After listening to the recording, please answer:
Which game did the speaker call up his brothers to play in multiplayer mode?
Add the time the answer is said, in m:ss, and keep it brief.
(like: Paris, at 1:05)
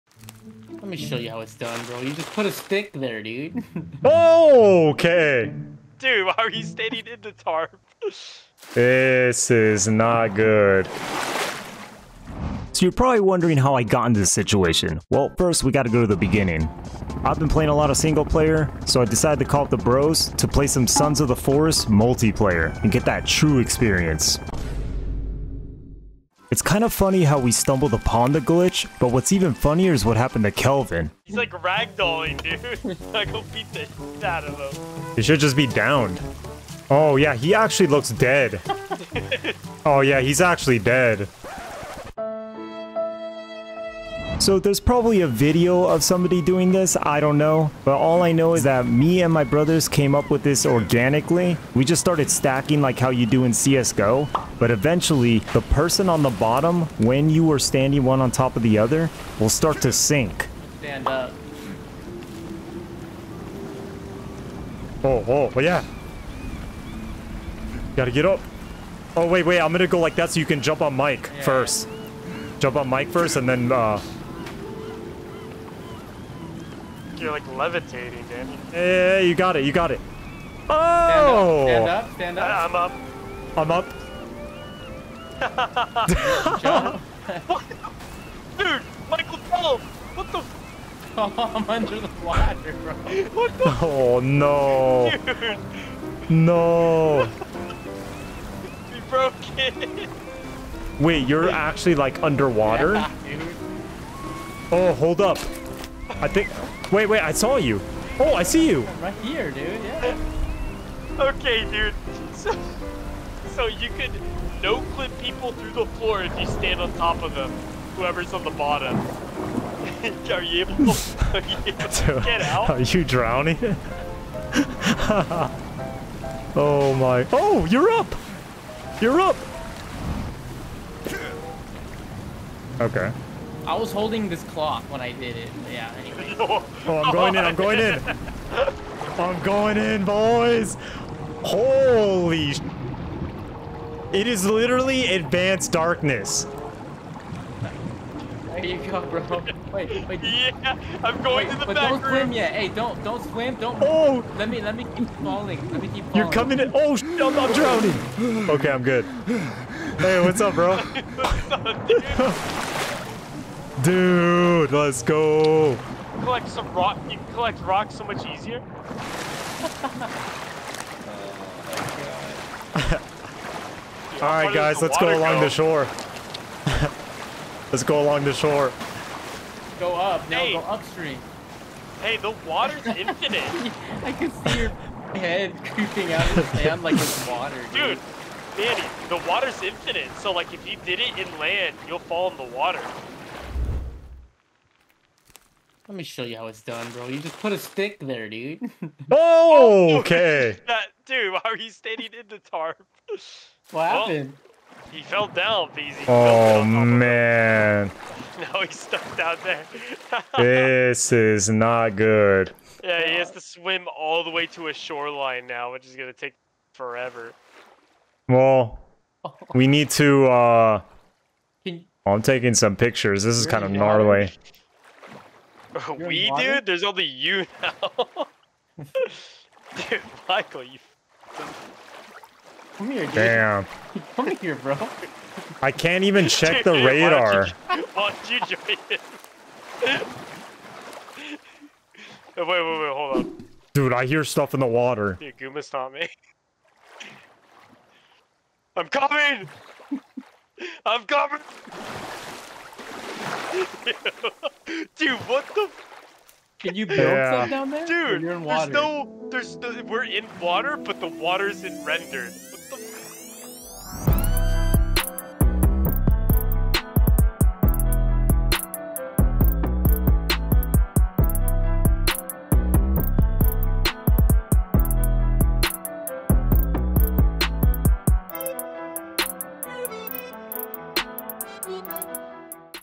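Sons of the Forest, at 0:20.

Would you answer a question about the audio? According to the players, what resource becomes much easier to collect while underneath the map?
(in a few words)
Rocks.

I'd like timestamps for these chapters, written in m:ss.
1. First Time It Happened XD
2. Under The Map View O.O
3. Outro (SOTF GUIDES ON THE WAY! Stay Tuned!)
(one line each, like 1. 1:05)
1. 1:05
2. 2:10
3. 4:24.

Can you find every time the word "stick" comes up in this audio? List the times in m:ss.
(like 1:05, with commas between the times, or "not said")
0:02, 3:17.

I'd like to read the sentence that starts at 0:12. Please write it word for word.
So you're probably wondering how I got into this situation.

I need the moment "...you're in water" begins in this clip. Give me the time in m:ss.
4:18.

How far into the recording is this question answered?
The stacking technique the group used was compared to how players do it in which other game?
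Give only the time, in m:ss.
0:53.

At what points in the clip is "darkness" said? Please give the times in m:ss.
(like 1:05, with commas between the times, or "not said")
2:25.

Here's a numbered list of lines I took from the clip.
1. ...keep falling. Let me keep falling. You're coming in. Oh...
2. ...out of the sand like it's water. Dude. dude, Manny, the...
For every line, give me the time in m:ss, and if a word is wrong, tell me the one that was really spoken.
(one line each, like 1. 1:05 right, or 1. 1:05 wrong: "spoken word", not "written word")
1. 2:34 right
2. 3:06 right.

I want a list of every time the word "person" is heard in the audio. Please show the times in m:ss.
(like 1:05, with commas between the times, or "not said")
0:55.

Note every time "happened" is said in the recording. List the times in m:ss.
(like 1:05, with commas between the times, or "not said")
0:30, 3:23.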